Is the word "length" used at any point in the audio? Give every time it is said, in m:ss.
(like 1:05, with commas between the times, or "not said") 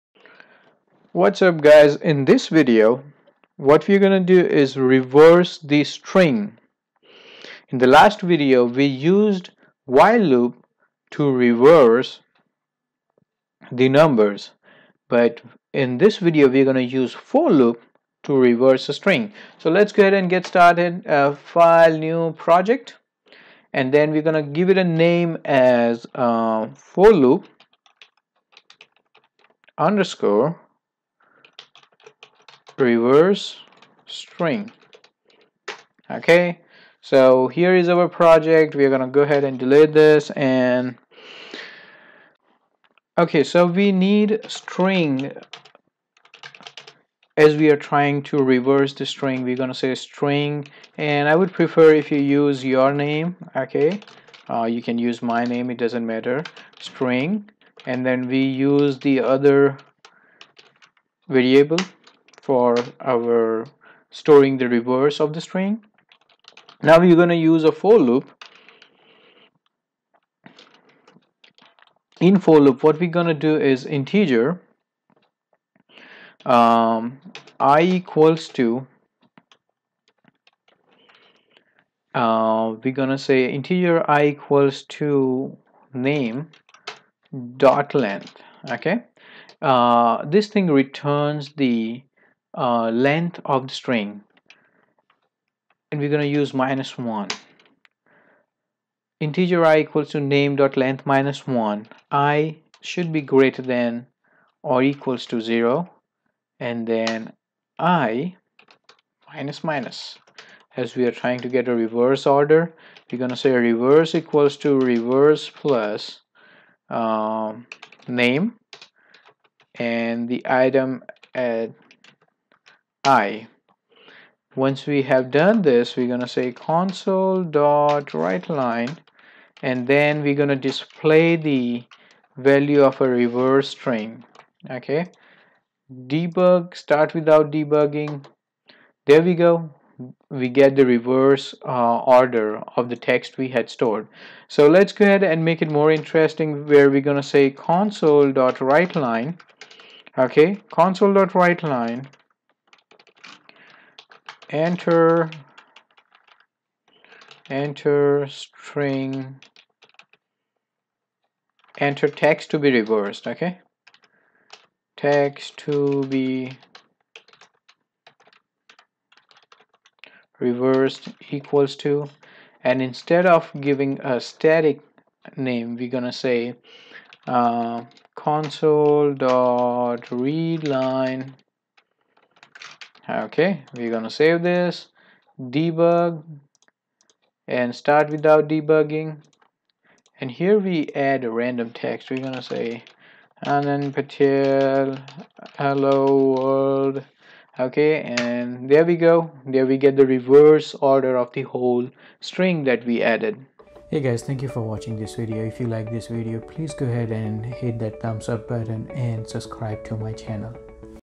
1:27, 1:32, 1:40.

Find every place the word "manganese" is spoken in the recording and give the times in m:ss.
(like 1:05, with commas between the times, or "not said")
not said.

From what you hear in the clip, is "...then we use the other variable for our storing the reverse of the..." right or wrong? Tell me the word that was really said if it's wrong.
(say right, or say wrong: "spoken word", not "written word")
right.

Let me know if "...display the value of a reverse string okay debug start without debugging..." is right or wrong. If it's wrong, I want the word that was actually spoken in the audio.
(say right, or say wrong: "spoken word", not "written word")
right.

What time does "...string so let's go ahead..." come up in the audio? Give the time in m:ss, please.
0:18.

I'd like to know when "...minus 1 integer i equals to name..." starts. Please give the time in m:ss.
1:36.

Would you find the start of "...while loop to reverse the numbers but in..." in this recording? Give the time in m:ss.
0:09.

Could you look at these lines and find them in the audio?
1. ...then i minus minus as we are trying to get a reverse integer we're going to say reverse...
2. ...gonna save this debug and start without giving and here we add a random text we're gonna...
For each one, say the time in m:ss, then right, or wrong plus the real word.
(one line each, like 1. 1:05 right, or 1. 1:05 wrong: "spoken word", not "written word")
1. 1:46 wrong: "order", not "integer"
2. 3:03 wrong: "debugging", not "giving".